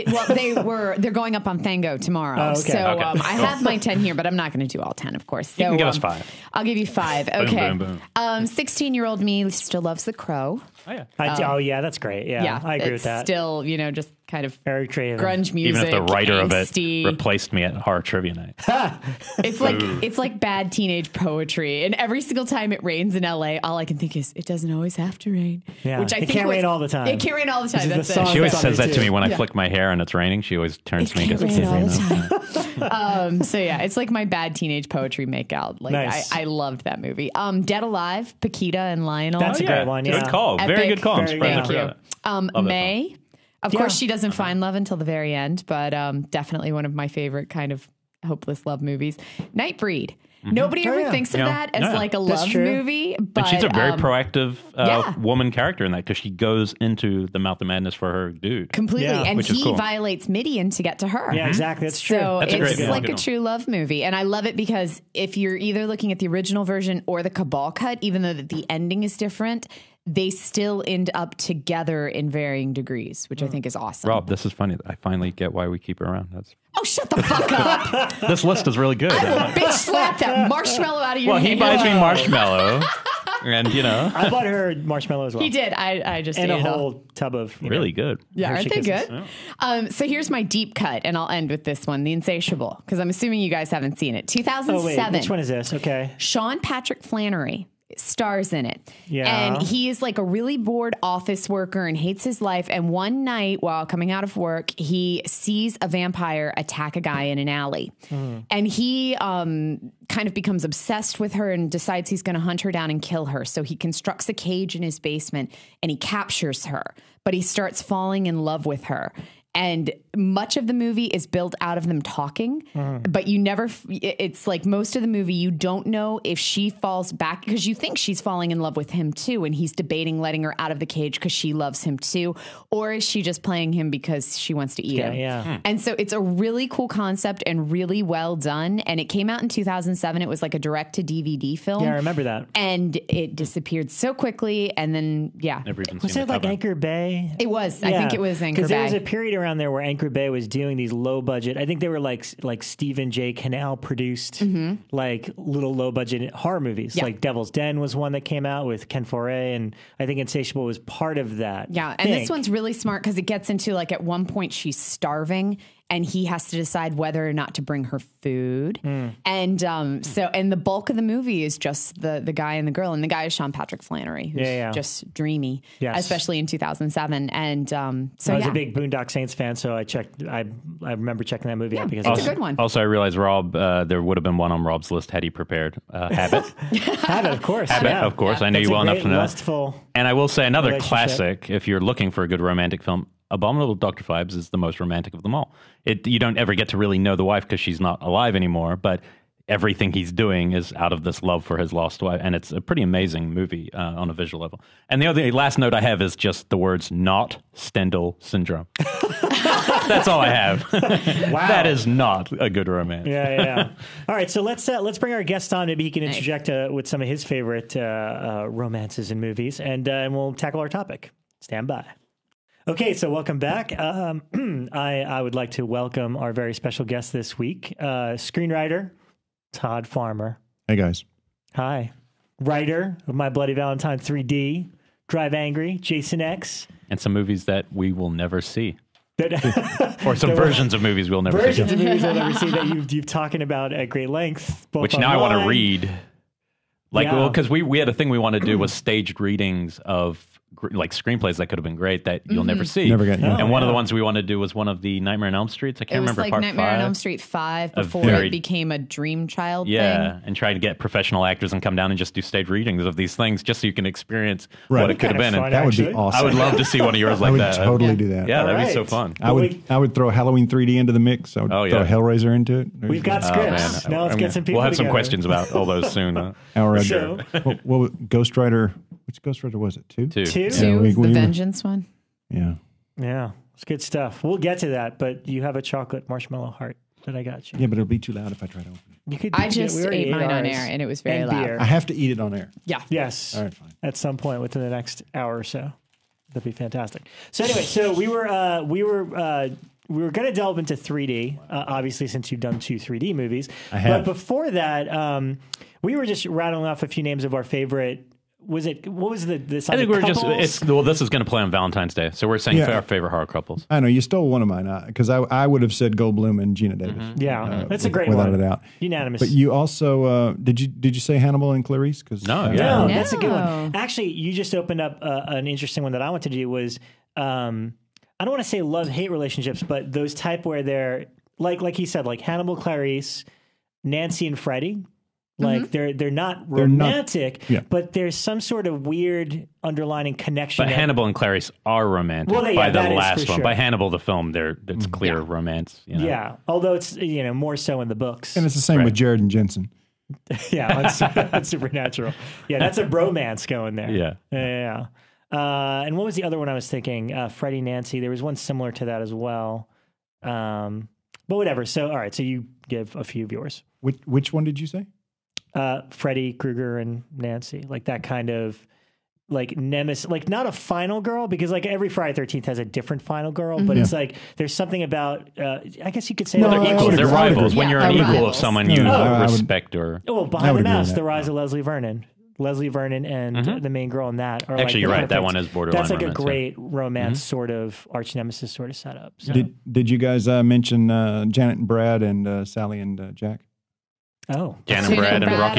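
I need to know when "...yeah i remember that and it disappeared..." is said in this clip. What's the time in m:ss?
2:21.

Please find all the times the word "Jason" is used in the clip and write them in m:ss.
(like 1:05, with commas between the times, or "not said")
3:55.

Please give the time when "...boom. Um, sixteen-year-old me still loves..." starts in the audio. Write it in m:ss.
0:07.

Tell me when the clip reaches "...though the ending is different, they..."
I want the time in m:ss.
1:08.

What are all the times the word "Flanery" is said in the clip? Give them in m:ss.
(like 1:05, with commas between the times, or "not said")
1:37, 2:53.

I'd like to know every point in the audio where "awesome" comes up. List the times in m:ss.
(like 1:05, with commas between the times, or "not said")
1:13, 4:25.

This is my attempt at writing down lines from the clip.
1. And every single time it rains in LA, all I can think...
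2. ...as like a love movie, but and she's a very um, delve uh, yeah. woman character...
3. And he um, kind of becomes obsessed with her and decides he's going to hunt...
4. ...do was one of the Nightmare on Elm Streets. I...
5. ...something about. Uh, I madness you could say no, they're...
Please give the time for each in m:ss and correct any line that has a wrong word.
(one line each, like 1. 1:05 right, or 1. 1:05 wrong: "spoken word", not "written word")
1. 0:21 right
2. 0:51 wrong: "proactive", not "delve"
3. 1:48 right
4. 4:14 right
5. 6:14 wrong: "guess", not "madness".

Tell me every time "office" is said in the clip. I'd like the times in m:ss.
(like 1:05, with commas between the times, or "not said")
1:41.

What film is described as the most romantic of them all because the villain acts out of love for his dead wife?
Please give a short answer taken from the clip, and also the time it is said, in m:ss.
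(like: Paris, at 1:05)
Abominable Dr. Phibes, at 3:13.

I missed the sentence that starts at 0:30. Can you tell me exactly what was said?
She always turns it to me.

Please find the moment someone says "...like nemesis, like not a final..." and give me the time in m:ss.
6:09.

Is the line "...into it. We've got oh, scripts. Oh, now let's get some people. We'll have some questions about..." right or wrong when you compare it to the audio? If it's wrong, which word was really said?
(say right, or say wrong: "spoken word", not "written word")
right.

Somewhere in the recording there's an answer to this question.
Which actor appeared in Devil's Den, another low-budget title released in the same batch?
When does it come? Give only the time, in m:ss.
2:38.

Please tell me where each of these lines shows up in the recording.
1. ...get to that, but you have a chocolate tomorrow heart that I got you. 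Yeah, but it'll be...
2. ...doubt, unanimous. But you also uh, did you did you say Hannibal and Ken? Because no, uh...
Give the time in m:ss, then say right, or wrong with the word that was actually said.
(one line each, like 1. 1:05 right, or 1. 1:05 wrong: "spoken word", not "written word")
1. 4:44 wrong: "marshmallow", not "tomorrow"
2. 5:18 wrong: "Clarice", not "Ken".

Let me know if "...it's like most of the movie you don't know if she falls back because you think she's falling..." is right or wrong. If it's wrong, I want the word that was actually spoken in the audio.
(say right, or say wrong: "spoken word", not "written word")
right.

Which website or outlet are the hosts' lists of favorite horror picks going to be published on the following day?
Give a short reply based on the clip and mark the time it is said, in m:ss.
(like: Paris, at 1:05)
Fango, at 0:01.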